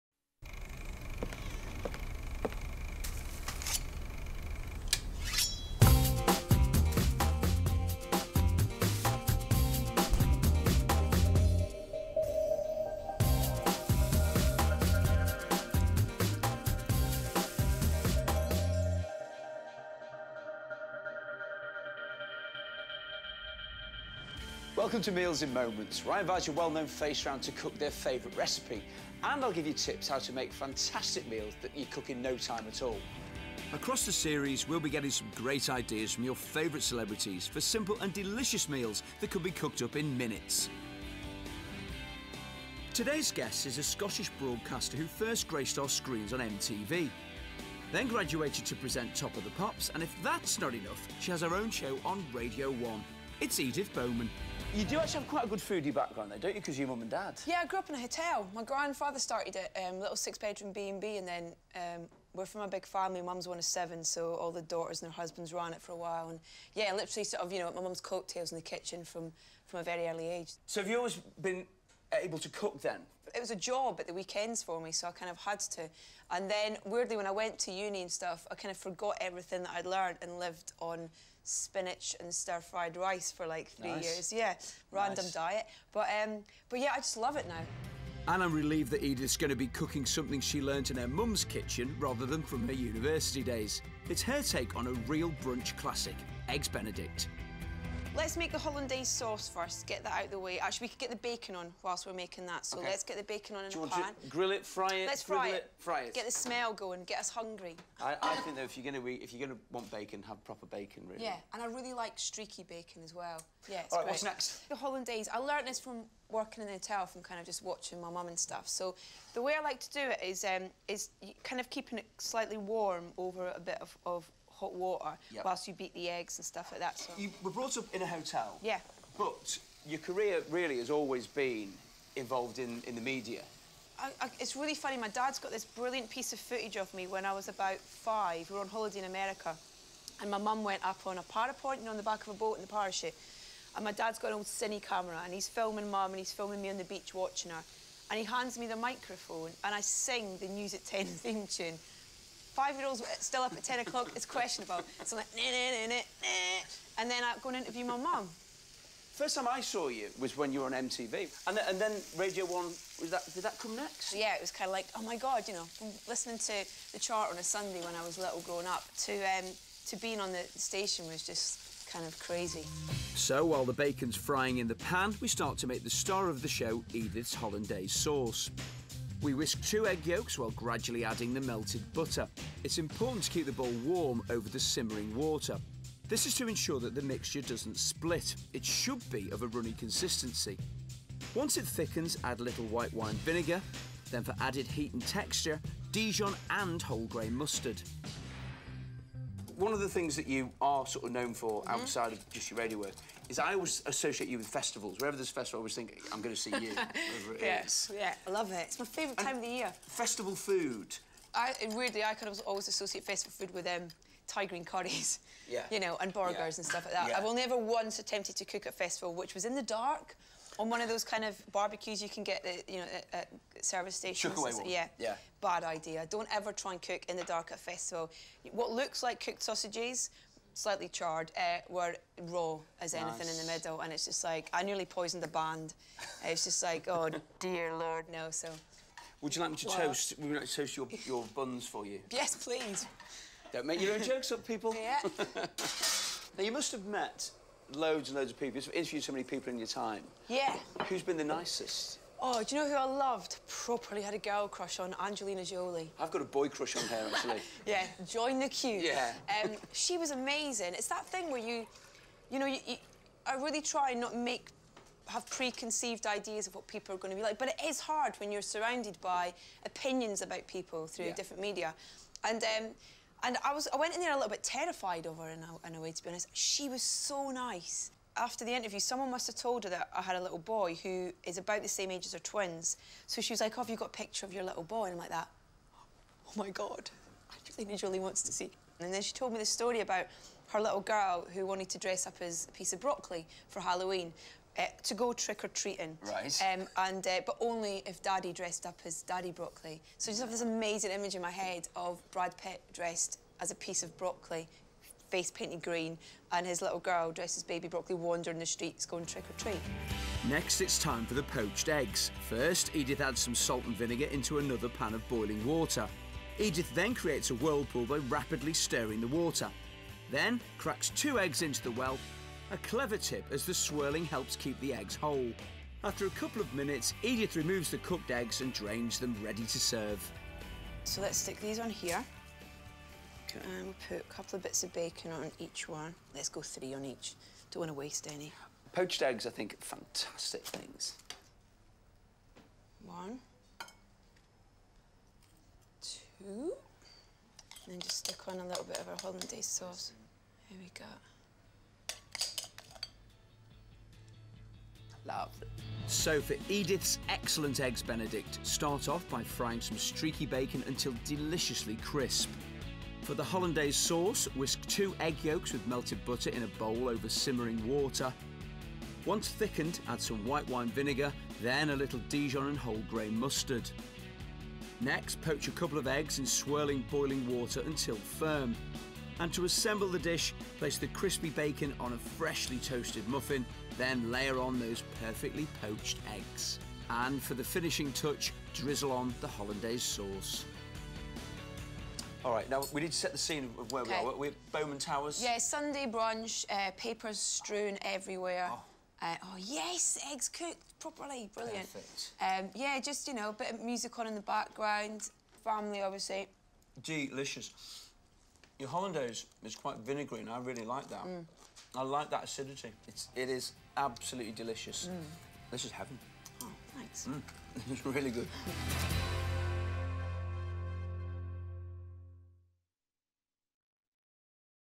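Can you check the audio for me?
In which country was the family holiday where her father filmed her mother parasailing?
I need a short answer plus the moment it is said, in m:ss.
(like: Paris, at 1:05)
America, at 2:19.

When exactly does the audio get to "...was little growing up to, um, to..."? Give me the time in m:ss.
2:48.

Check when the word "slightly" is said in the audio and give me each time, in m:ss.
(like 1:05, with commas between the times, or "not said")
2:02, 3:50.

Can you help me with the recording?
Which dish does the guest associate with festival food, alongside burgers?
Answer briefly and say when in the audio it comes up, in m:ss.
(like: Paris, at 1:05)
Thai green curries, at 3:34.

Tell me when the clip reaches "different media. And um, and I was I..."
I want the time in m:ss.
4:31.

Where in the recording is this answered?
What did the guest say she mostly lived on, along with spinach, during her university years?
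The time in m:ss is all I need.
1:22.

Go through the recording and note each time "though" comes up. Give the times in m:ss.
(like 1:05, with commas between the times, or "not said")
0:56, 1:48.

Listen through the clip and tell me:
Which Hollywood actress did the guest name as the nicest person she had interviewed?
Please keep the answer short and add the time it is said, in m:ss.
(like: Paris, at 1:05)
Angelina Jolie, at 4:15.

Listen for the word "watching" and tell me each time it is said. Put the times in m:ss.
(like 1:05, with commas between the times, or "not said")
1:57, 2:27.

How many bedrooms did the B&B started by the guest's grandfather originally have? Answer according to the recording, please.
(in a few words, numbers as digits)
6.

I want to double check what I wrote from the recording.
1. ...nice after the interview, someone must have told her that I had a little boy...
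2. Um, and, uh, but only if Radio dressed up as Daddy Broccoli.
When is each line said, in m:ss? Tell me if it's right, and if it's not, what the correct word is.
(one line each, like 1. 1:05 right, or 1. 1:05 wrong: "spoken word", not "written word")
1. 4:37 right
2. 4:56 wrong: "Daddy", not "Radio".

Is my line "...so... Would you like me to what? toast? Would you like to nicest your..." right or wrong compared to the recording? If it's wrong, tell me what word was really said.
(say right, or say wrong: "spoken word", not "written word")
wrong: "toast", not "nicest".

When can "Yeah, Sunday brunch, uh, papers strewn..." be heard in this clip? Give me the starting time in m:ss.
6:35.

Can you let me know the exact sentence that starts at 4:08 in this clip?
You've interviewed so many people in your time.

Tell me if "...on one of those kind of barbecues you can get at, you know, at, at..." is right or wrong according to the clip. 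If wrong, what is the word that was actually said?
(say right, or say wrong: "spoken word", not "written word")
right.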